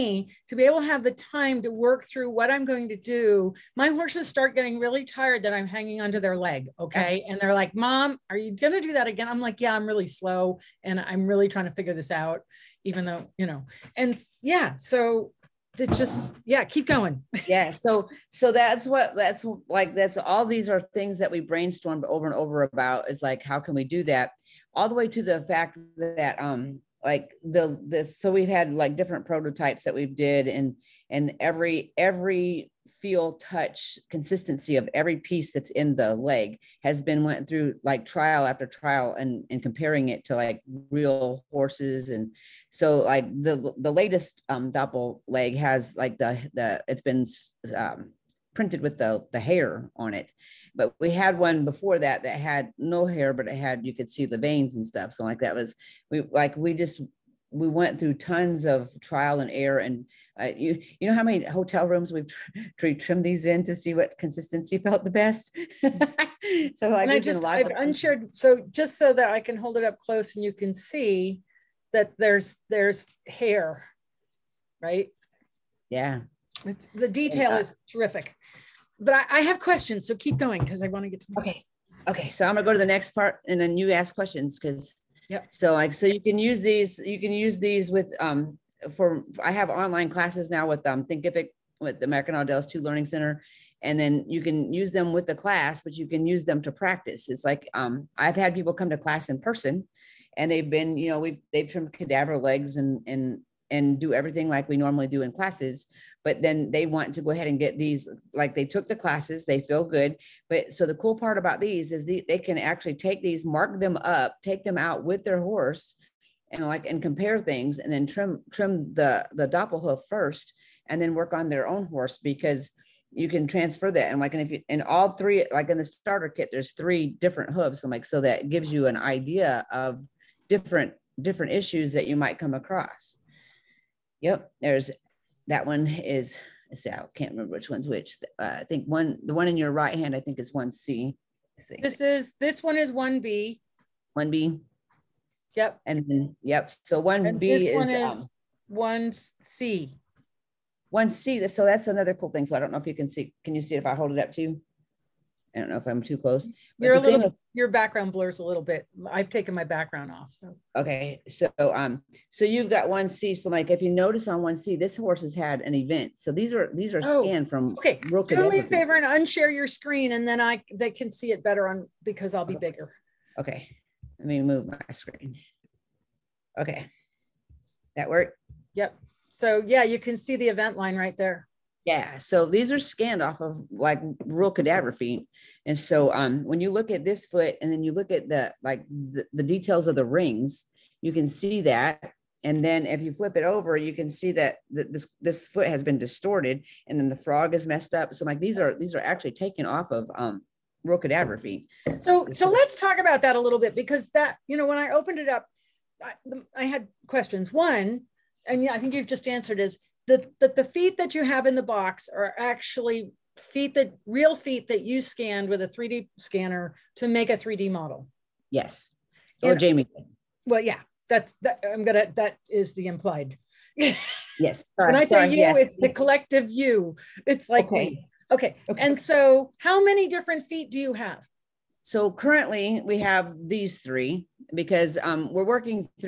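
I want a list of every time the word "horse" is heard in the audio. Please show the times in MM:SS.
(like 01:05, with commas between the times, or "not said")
00:03, 00:41, 01:55, 02:01, 02:44.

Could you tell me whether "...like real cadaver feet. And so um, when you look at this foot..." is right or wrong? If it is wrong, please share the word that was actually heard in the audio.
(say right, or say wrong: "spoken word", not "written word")
right.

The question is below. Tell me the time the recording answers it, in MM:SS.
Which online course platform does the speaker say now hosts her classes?
01:31.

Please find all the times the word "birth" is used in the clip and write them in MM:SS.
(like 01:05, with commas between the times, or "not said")
not said.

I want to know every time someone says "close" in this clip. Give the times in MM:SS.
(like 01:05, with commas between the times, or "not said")
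01:09, 02:36.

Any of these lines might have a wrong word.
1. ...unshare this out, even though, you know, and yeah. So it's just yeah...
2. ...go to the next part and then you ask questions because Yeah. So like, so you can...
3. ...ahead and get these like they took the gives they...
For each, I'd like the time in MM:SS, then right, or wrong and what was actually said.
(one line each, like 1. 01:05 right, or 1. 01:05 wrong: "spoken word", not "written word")
1. 00:11 wrong: "figure", not "unshare"
2. 01:22 wrong: "Yep", not "Yeah"
3. 01:47 wrong: "classes", not "gives".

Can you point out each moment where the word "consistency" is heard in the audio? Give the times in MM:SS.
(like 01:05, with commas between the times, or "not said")
00:34, 01:04.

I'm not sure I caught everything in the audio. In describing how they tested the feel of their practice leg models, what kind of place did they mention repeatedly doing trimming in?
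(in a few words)
Hotel rooms.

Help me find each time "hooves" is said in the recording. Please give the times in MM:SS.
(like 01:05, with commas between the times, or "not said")
02:07.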